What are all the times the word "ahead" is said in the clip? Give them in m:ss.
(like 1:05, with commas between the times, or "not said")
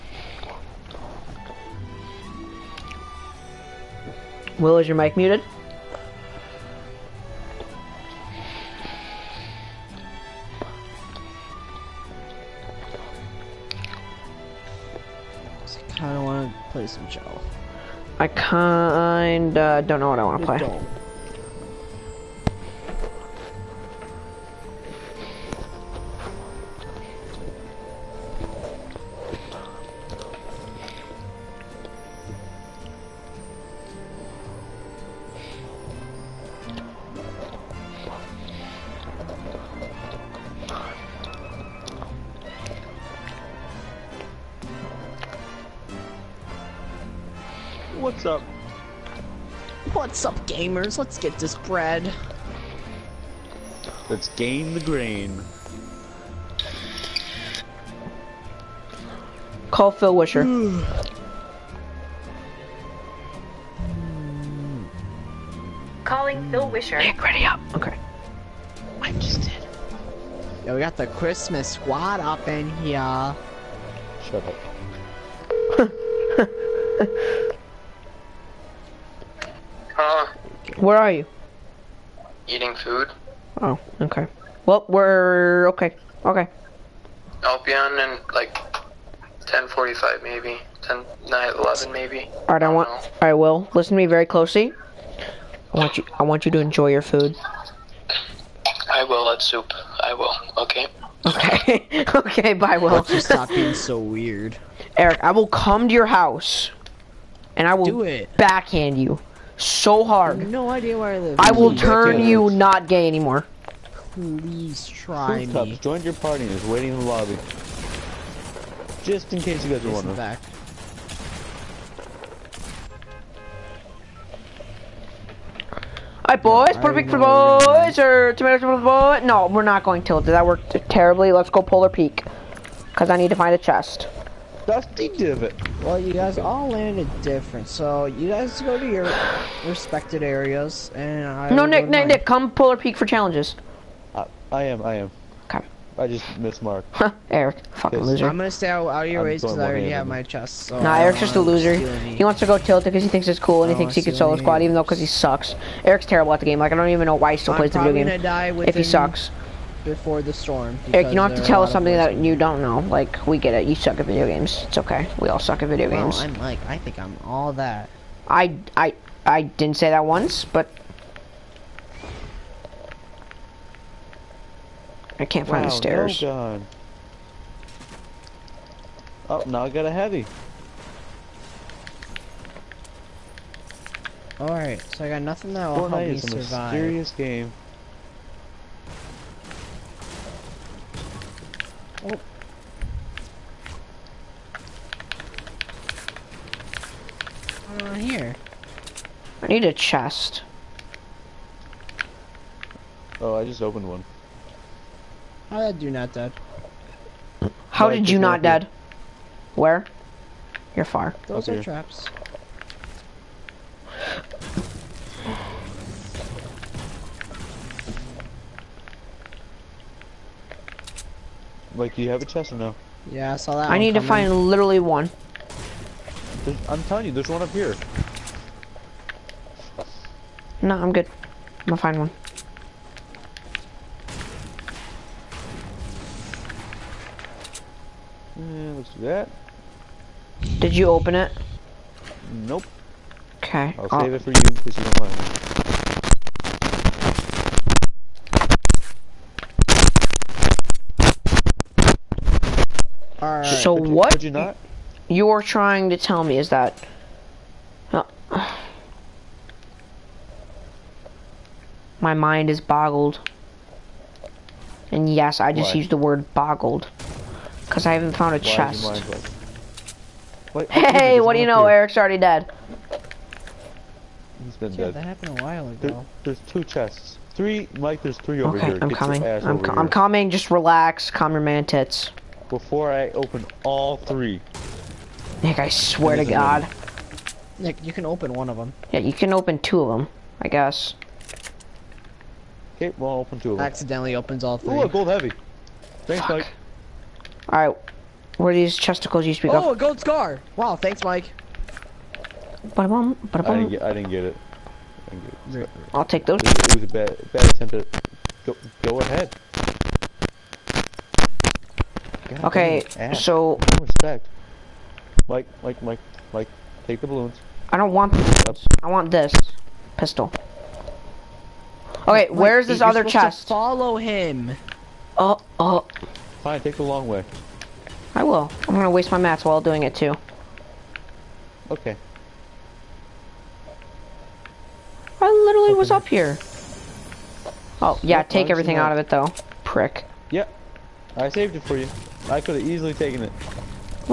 5:09.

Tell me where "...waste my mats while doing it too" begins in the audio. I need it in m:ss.
5:28.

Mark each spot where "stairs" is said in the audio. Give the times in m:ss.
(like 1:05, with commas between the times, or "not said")
2:55.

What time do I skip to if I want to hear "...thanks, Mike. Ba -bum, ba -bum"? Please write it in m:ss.
5:00.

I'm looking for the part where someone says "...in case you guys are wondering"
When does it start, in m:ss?
1:59.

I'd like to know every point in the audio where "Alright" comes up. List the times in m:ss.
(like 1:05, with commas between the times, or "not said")
2:06, 3:04, 4:57.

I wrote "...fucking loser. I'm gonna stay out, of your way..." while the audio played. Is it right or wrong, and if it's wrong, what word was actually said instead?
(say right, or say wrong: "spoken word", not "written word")
right.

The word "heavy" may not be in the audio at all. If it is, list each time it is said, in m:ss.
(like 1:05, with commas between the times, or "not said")
2:59, 4:55.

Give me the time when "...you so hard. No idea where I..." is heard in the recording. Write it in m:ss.
1:48.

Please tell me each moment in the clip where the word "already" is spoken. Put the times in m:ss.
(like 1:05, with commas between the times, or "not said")
2:29, 4:31.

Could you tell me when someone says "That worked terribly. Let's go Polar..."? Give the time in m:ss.
2:10.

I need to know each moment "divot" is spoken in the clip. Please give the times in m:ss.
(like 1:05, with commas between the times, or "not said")
2:15.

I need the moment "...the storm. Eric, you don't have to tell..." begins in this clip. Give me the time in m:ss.
2:40.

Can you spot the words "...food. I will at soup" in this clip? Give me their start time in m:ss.
1:37.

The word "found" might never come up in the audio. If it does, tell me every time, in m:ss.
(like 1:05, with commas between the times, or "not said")
4:28.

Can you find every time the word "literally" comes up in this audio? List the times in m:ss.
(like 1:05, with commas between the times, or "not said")
3:44, 5:35.